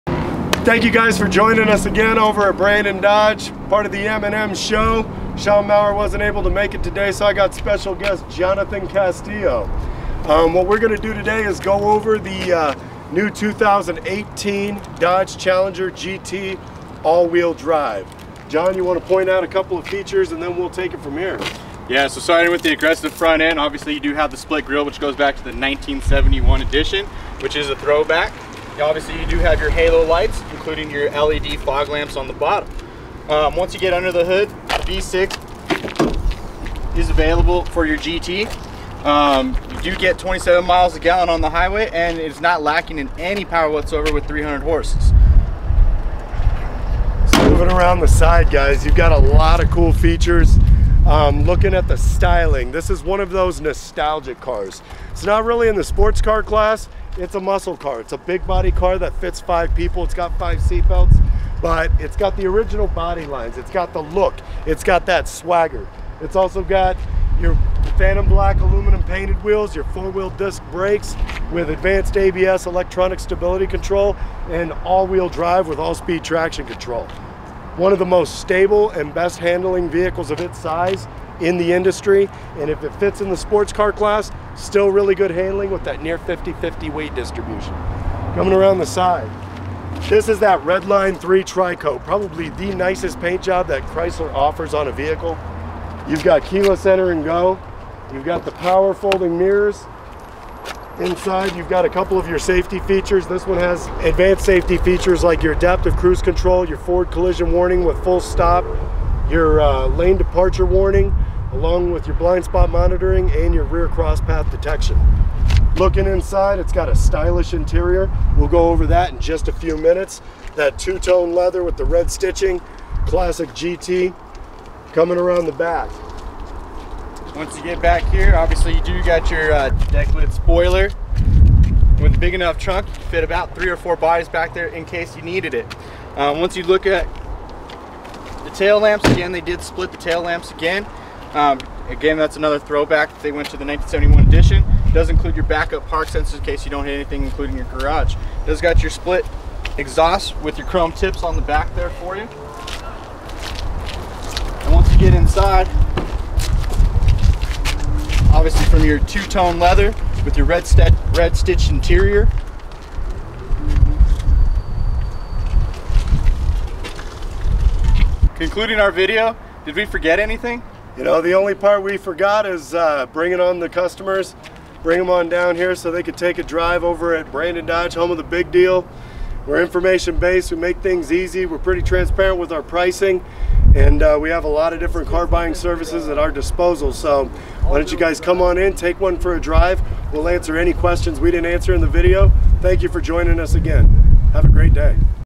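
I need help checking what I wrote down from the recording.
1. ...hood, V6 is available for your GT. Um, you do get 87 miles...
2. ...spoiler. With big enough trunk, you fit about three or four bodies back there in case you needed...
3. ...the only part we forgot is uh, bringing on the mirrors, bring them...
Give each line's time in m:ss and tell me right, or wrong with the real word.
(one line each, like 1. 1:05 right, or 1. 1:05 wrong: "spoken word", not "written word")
1. 0:34 wrong: "27", not "87"
2. 2:10 right
3. 2:51 wrong: "customers", not "mirrors".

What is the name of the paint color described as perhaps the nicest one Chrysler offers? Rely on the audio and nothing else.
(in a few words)
Redline 3 Tricoat.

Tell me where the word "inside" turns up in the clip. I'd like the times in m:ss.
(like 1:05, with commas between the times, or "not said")
1:40, 1:56, 2:35.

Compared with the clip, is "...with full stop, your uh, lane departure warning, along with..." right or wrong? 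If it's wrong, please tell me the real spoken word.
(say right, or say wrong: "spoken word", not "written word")
right.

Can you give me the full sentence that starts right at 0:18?
John, you wanna point out a couple of features and then we'll take it from here.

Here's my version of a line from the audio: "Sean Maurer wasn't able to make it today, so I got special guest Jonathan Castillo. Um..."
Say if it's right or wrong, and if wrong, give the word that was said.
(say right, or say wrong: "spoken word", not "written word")
right.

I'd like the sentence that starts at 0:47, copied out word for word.
So moving around the side guys, you've got a lot of cool features.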